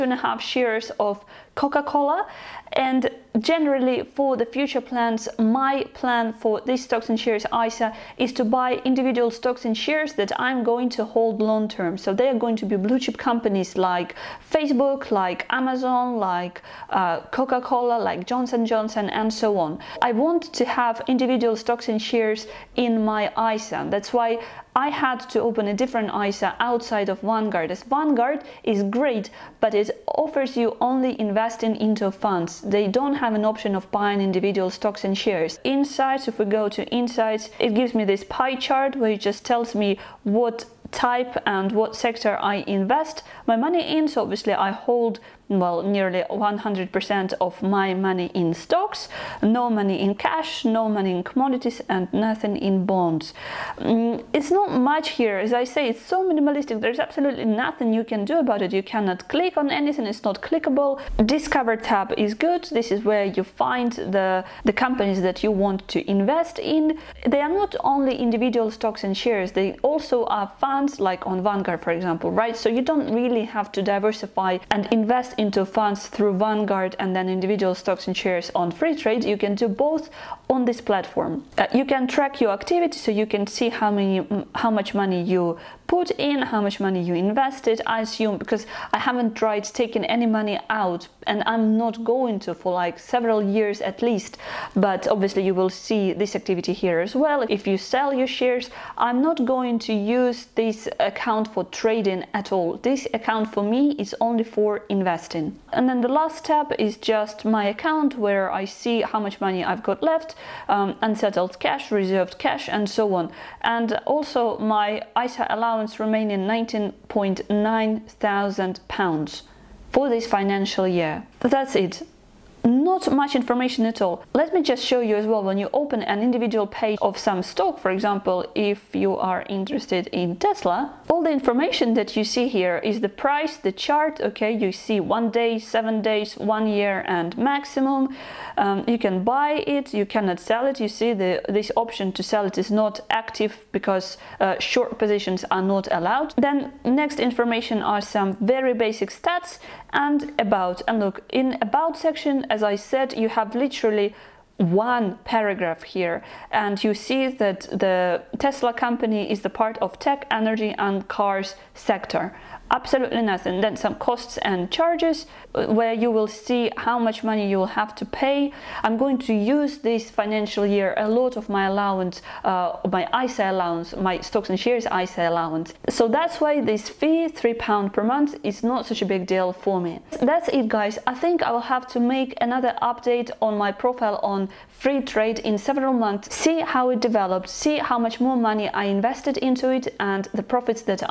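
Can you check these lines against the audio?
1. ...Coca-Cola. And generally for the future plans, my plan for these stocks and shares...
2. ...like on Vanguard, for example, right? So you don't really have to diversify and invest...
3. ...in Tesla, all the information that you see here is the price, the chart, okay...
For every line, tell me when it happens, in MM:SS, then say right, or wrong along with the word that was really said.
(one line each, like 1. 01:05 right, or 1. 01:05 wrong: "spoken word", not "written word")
1. 00:01 right
2. 01:10 right
3. 02:10 right.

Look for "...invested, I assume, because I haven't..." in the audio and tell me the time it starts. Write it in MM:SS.
01:27.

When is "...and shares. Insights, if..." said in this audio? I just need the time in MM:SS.
00:35.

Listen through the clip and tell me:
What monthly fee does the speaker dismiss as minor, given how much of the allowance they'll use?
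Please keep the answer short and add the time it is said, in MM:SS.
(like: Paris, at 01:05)
£3 per month, at 02:57.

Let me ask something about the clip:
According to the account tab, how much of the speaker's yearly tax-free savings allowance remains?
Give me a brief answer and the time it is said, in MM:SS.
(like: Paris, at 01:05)
£19.9 thousand, at 01:56.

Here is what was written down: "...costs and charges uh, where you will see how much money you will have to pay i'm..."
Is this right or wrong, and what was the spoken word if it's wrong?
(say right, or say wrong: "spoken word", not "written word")
right.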